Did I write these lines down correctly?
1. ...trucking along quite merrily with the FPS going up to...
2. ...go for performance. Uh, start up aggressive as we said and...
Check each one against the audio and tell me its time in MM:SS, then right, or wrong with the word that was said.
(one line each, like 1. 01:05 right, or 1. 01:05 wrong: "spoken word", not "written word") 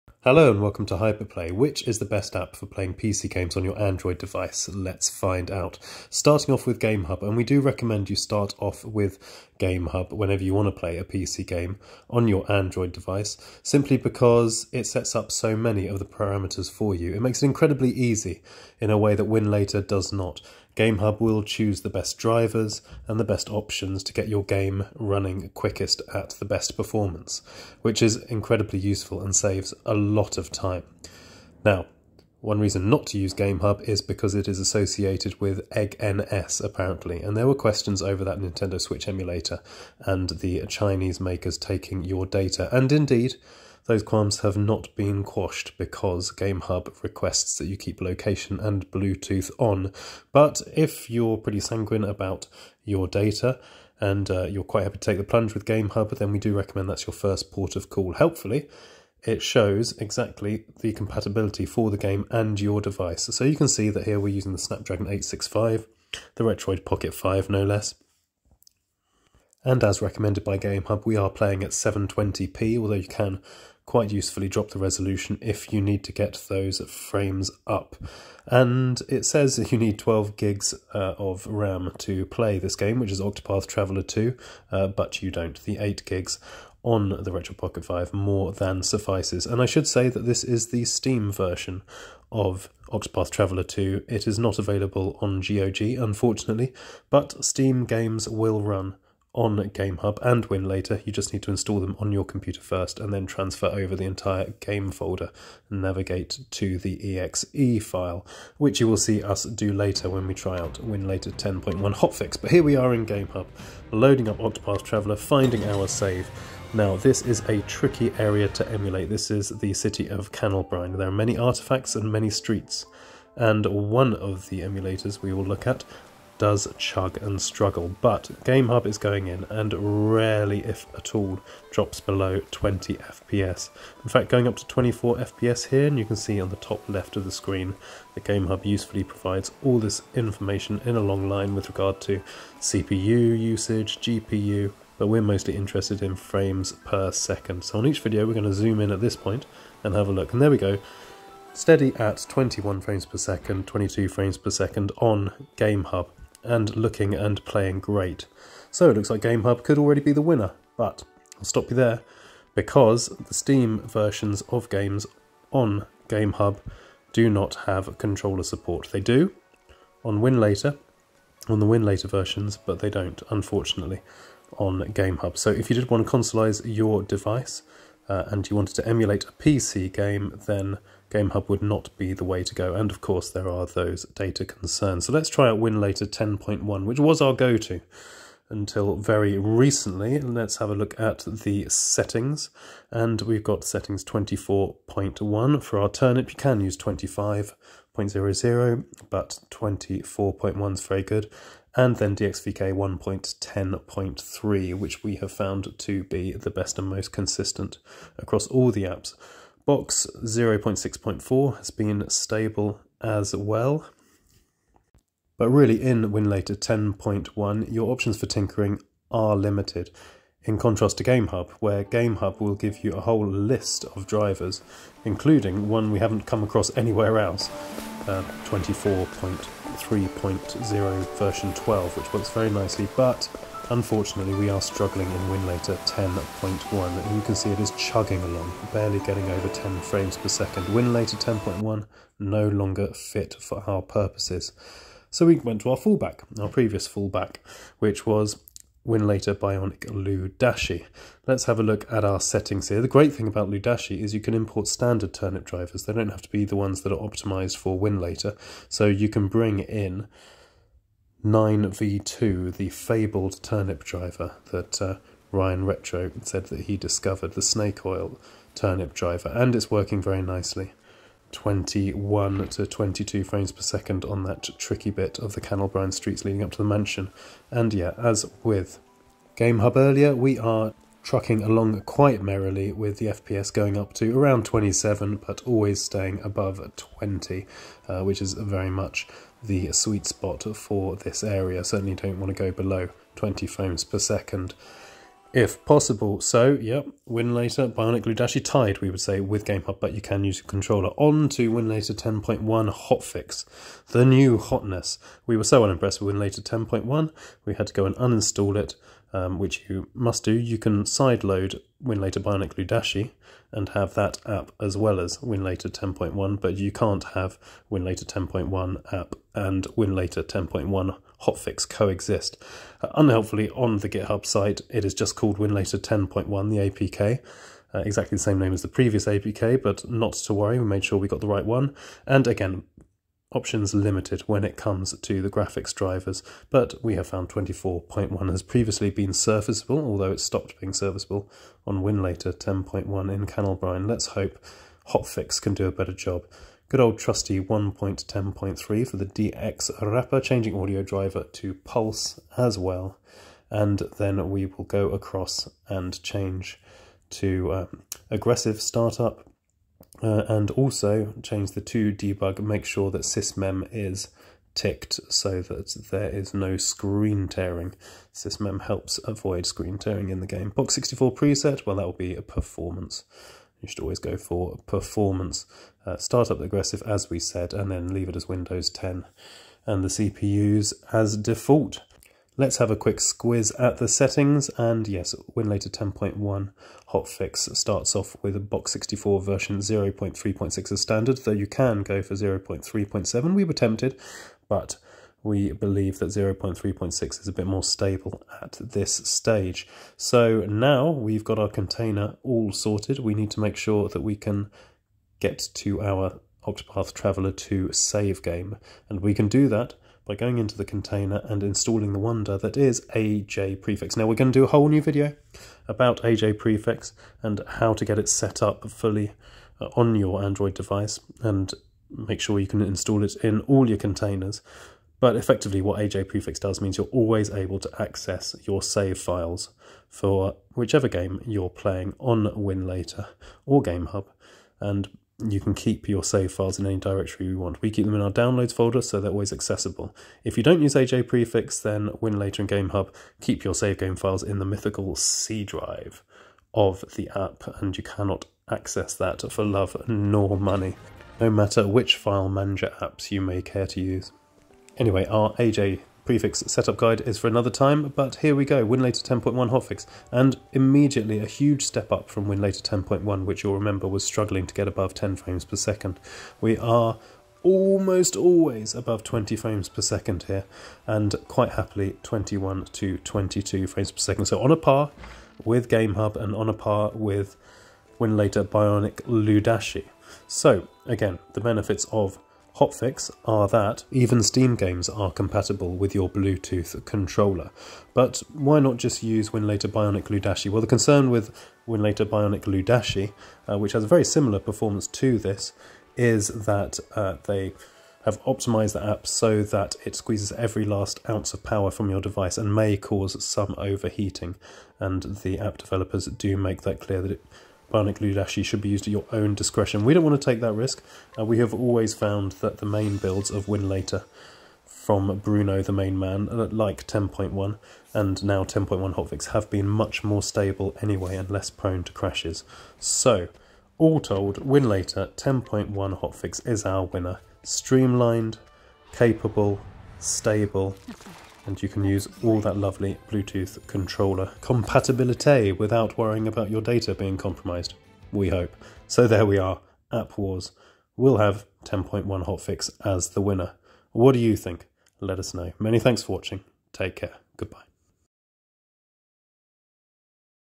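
1. 04:41 right
2. 06:13 right.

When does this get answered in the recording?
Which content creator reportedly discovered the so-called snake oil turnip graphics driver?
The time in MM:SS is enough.
04:25.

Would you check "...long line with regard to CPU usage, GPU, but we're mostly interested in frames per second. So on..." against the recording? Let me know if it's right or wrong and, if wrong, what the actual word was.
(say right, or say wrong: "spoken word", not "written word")
right.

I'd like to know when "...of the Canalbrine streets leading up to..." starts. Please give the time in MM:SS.
04:35.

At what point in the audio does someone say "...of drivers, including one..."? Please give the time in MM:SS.
03:43.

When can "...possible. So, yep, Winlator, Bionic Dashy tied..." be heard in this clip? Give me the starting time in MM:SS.
04:55.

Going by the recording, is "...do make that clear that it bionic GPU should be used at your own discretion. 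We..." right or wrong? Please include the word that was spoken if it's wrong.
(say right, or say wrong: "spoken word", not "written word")
wrong: "Ludashi", not "GPU".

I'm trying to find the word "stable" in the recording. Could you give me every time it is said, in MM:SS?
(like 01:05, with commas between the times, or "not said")
03:32, 06:37, 08:40, 08:49.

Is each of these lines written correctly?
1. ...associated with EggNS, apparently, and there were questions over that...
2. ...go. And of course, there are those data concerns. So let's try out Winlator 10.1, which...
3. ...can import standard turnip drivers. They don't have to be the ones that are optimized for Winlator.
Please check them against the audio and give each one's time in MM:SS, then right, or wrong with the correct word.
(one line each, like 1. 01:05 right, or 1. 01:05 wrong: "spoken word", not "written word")
1. 00:34 right
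2. 03:02 right
3. 04:14 right.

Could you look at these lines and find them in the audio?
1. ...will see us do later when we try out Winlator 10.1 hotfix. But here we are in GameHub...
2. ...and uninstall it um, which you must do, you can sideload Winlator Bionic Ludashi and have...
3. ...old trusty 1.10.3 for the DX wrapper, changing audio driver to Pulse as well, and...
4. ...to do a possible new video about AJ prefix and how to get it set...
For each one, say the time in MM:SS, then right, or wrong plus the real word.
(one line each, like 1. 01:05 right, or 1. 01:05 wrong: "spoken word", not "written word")
1. 01:48 right
2. 05:07 right
3. 05:46 right
4. 06:54 wrong: "whole", not "possible".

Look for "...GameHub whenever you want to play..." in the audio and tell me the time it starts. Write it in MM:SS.
00:09.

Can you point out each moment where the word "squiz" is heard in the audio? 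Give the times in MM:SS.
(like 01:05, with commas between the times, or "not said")
06:22.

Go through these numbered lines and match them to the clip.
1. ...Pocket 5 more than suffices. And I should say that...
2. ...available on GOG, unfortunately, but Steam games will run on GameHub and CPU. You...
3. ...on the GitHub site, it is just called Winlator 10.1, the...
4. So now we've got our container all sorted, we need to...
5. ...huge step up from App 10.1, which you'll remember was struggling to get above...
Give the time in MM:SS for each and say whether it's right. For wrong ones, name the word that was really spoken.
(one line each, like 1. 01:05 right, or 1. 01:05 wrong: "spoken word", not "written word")
1. 01:27 right
2. 01:34 wrong: "Winlator", not "CPU"
3. 05:23 right
4. 06:39 right
5. 07:41 wrong: "Winlator", not "App".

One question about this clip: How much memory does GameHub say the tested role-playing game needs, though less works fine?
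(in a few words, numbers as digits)
12 GB.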